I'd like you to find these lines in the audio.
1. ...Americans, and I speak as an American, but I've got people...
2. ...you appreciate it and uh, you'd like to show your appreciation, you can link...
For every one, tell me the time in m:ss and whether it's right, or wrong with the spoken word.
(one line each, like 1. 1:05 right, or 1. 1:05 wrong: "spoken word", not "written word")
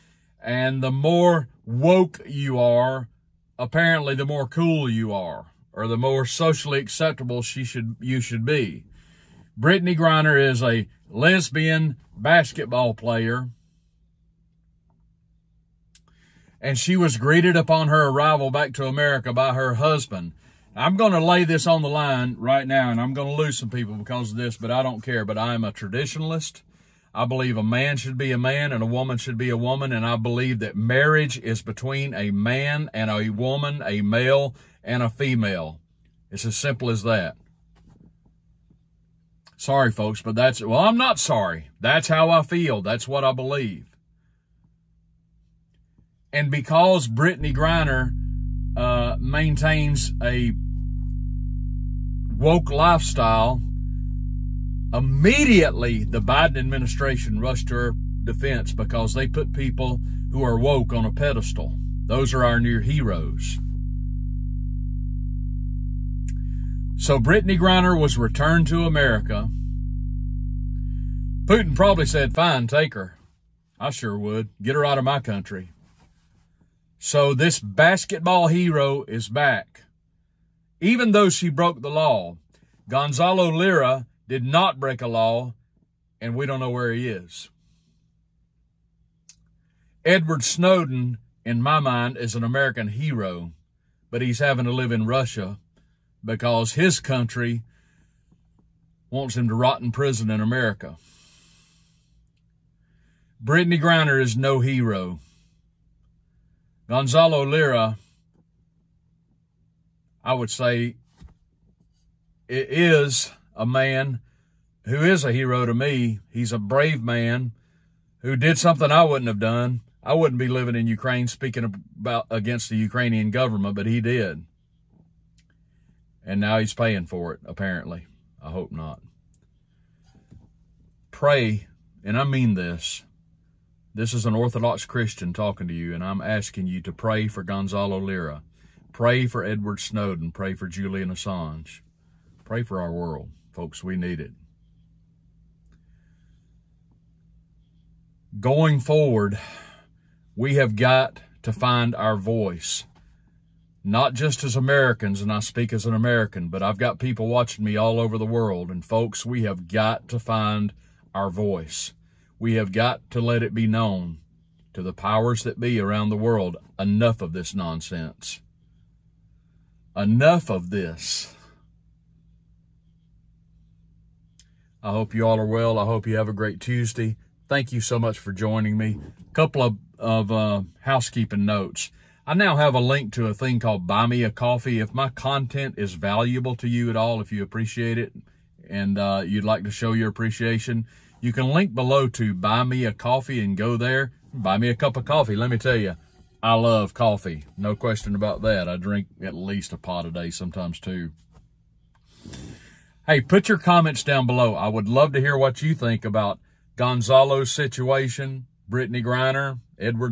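1. 2:34 right
2. 3:07 right.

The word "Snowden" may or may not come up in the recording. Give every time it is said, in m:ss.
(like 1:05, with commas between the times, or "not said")
1:30, 2:19.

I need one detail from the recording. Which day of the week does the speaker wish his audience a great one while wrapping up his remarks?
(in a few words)
Tuesday.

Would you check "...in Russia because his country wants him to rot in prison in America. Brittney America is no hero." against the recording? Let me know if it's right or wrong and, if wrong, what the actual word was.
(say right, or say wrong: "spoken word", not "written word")
wrong: "Griner", not "America".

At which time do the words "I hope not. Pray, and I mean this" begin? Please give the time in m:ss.
2:08.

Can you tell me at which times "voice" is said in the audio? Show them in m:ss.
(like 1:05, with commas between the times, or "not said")
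2:32, 2:41.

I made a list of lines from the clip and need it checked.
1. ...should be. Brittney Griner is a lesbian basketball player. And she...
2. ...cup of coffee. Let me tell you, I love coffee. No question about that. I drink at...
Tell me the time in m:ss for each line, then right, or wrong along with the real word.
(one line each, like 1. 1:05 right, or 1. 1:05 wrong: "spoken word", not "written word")
1. 0:08 right
2. 3:14 right.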